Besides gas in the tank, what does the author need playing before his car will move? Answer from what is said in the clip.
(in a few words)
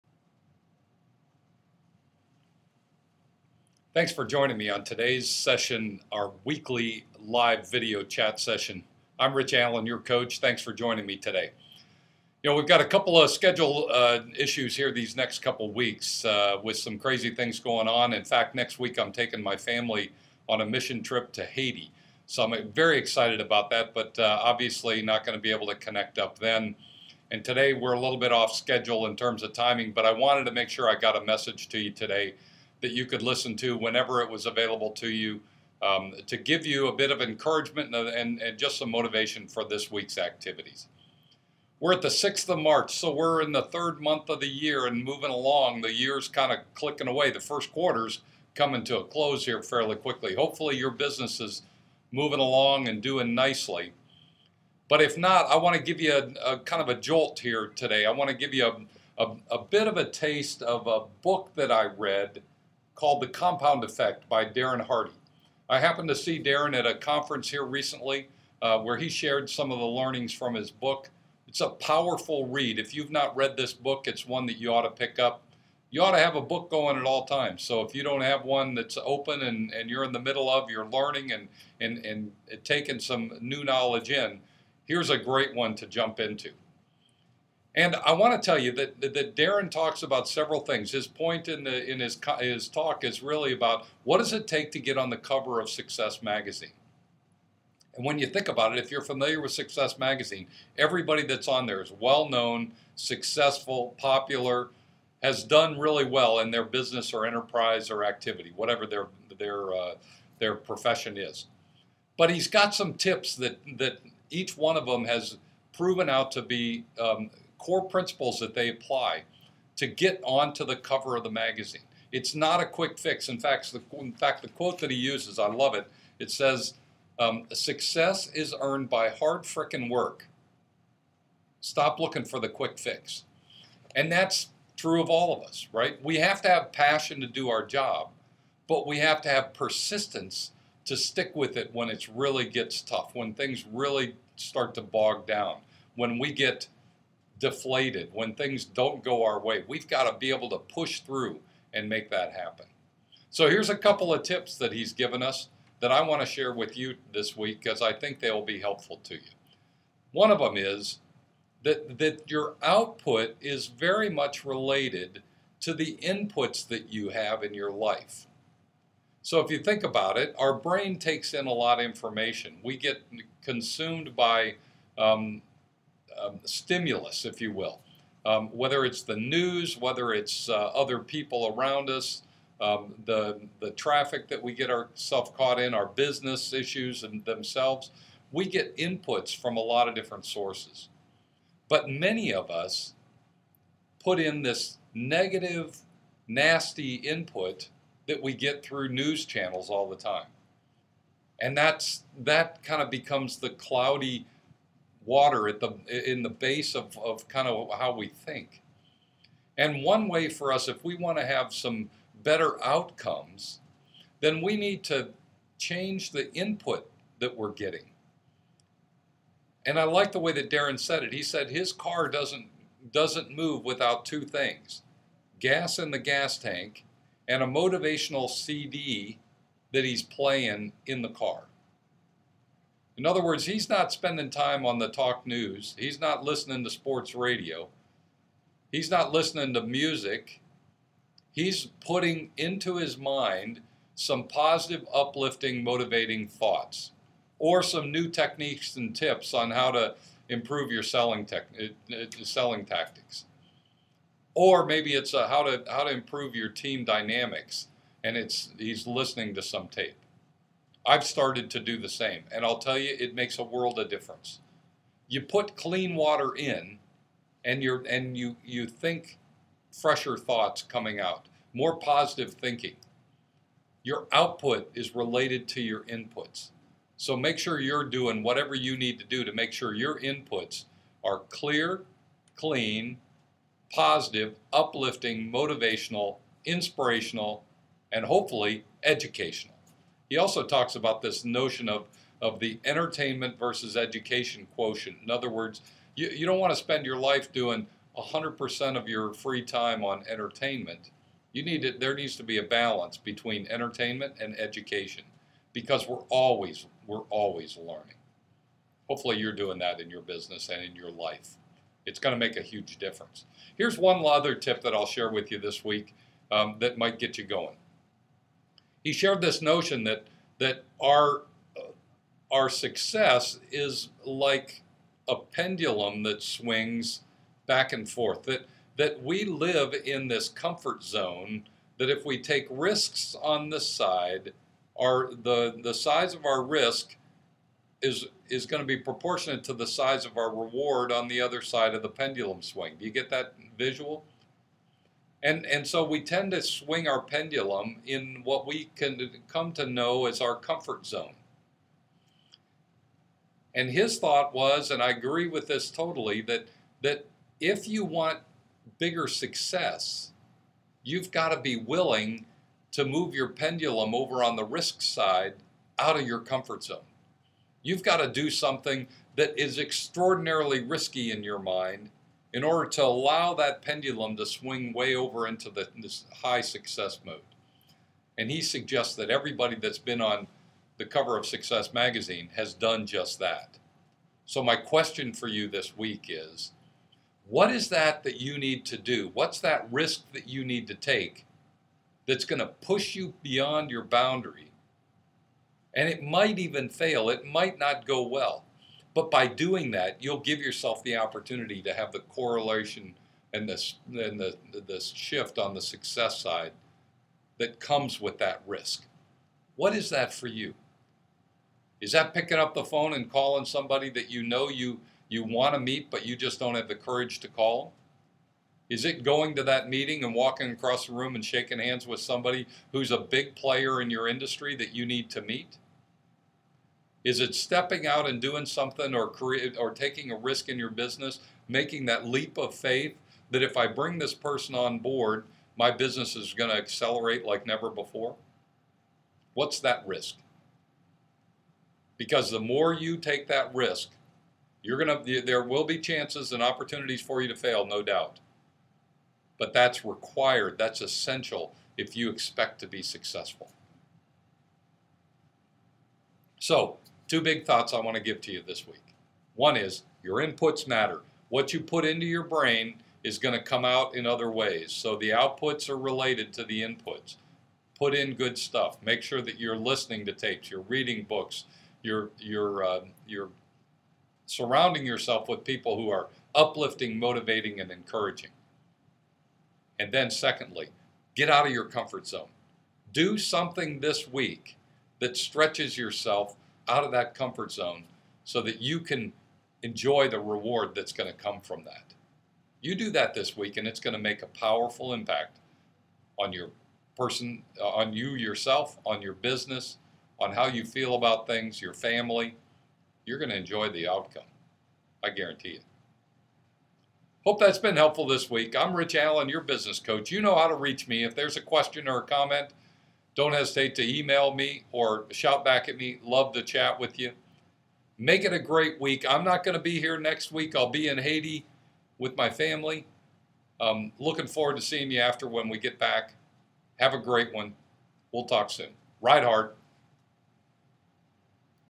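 a motivational CD.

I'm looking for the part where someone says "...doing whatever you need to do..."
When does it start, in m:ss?
4:37.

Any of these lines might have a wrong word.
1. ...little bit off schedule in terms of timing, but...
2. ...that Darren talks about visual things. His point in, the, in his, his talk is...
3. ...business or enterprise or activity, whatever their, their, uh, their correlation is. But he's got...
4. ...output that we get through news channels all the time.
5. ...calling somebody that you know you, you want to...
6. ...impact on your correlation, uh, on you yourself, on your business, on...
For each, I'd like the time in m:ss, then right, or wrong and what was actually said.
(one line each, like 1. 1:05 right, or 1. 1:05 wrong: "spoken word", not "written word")
1. 0:27 right
2. 1:28 wrong: "several", not "visual"
3. 1:46 wrong: "profession", not "correlation"
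4. 3:16 wrong: "input", not "output"
5. 6:53 right
6. 8:14 wrong: "person", not "correlation".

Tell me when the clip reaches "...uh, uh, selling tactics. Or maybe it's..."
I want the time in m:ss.
4:11.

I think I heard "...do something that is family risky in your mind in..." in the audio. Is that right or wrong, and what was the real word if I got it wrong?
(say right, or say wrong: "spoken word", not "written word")
wrong: "extraordinarily", not "family".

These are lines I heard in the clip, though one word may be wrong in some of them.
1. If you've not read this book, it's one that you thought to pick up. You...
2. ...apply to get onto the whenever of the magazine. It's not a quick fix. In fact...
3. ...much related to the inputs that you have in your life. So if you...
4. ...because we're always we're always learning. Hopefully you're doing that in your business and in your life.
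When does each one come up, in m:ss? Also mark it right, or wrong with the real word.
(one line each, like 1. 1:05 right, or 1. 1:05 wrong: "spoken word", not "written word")
1. 1:12 wrong: "ought", not "thought"
2. 1:58 wrong: "cover", not "whenever"
3. 2:44 right
4. 5:05 right.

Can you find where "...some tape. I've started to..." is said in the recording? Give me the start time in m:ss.
4:19.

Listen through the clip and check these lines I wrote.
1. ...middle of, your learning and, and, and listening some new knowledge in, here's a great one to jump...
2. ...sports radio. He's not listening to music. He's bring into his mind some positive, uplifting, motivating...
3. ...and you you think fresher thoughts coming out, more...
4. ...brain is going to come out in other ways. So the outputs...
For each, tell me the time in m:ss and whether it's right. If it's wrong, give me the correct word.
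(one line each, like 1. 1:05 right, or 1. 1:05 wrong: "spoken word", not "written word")
1. 1:20 wrong: "taking", not "listening"
2. 3:56 wrong: "putting", not "bring"
3. 4:27 right
4. 7:42 right.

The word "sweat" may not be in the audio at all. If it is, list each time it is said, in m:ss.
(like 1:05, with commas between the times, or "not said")
not said.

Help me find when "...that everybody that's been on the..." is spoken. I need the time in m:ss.
6:18.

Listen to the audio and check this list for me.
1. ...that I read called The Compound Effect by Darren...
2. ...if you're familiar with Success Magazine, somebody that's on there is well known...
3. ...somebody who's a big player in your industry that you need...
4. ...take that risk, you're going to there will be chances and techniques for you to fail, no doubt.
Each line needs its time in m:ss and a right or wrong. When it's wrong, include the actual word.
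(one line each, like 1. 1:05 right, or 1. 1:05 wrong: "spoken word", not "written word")
1. 1:01 right
2. 1:38 wrong: "everybody", not "somebody"
3. 7:01 right
4. 7:22 wrong: "opportunities", not "techniques".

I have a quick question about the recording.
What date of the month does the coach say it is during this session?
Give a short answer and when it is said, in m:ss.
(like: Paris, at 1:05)
6th of March, at 0:42.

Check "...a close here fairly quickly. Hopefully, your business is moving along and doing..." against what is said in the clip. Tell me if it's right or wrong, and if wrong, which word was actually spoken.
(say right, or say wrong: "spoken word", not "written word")
right.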